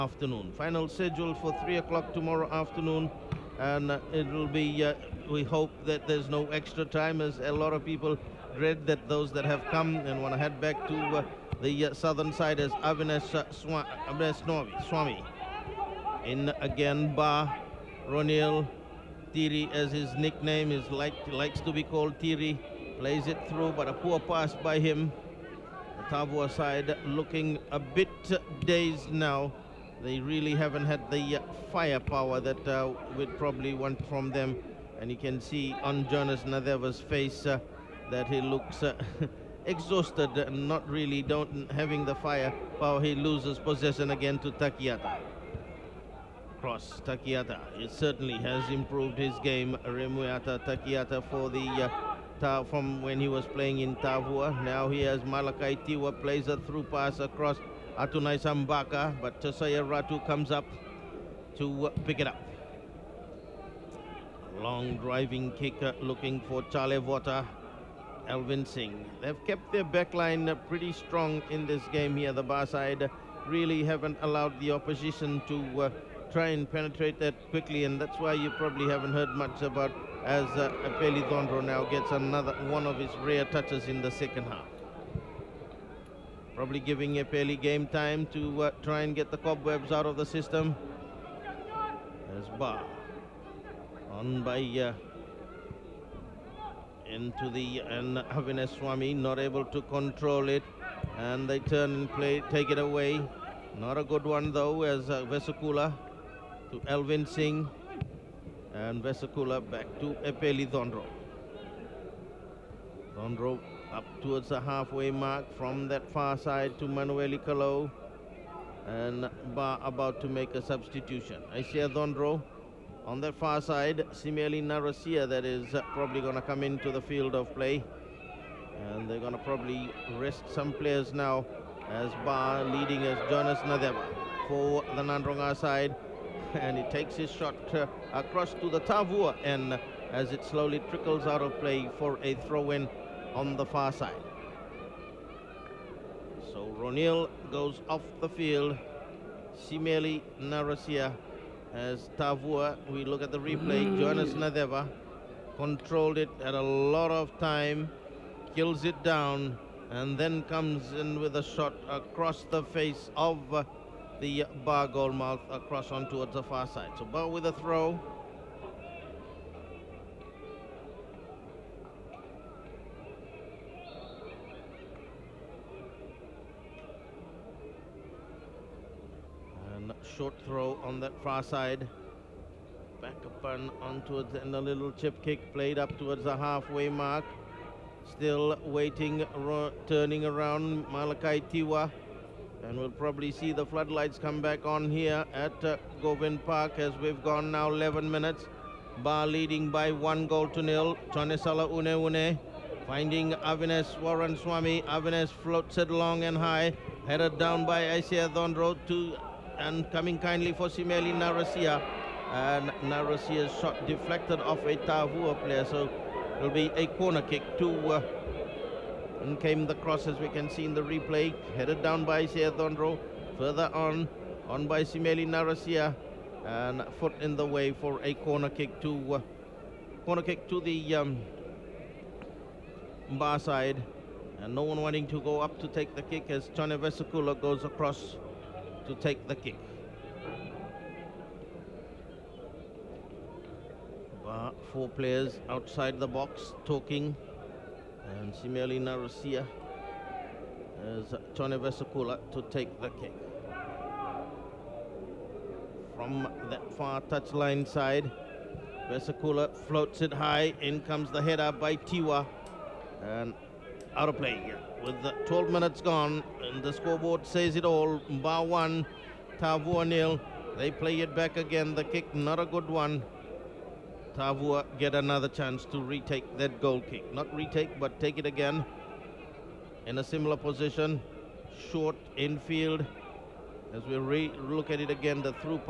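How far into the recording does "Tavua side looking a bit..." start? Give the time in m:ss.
0:26.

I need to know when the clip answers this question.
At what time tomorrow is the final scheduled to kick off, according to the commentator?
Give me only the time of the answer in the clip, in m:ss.
0:01.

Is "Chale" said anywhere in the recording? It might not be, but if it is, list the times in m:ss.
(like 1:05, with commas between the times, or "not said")
1:06.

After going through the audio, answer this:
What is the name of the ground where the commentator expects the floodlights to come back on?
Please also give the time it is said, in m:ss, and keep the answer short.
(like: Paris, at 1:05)
Govind Park, at 3:16.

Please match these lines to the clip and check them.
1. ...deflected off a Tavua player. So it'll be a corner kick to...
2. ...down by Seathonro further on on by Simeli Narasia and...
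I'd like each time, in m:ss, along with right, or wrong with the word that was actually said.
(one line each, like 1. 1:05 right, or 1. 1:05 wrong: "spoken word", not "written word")
1. 3:33 right
2. 3:41 right.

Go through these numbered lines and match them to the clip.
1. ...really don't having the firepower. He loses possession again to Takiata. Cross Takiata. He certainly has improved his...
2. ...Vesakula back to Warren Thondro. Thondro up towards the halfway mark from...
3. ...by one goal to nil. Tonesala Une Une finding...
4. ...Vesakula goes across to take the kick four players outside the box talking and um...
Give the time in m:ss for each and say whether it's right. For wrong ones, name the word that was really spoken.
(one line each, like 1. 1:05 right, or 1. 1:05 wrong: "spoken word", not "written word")
1. 0:40 right
2. 1:49 wrong: "Epeli", not "Warren"
3. 3:19 right
4. 3:56 right.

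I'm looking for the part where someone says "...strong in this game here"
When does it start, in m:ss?
1:10.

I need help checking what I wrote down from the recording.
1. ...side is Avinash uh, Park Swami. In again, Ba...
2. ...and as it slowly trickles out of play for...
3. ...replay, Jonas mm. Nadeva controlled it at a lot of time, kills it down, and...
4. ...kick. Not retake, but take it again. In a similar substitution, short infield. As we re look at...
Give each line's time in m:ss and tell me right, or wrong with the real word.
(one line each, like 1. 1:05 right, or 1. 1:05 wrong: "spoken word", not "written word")
1. 0:12 wrong: "Swa", not "Park"
2. 2:19 right
3. 2:33 right
4. 4:36 wrong: "position", not "substitution".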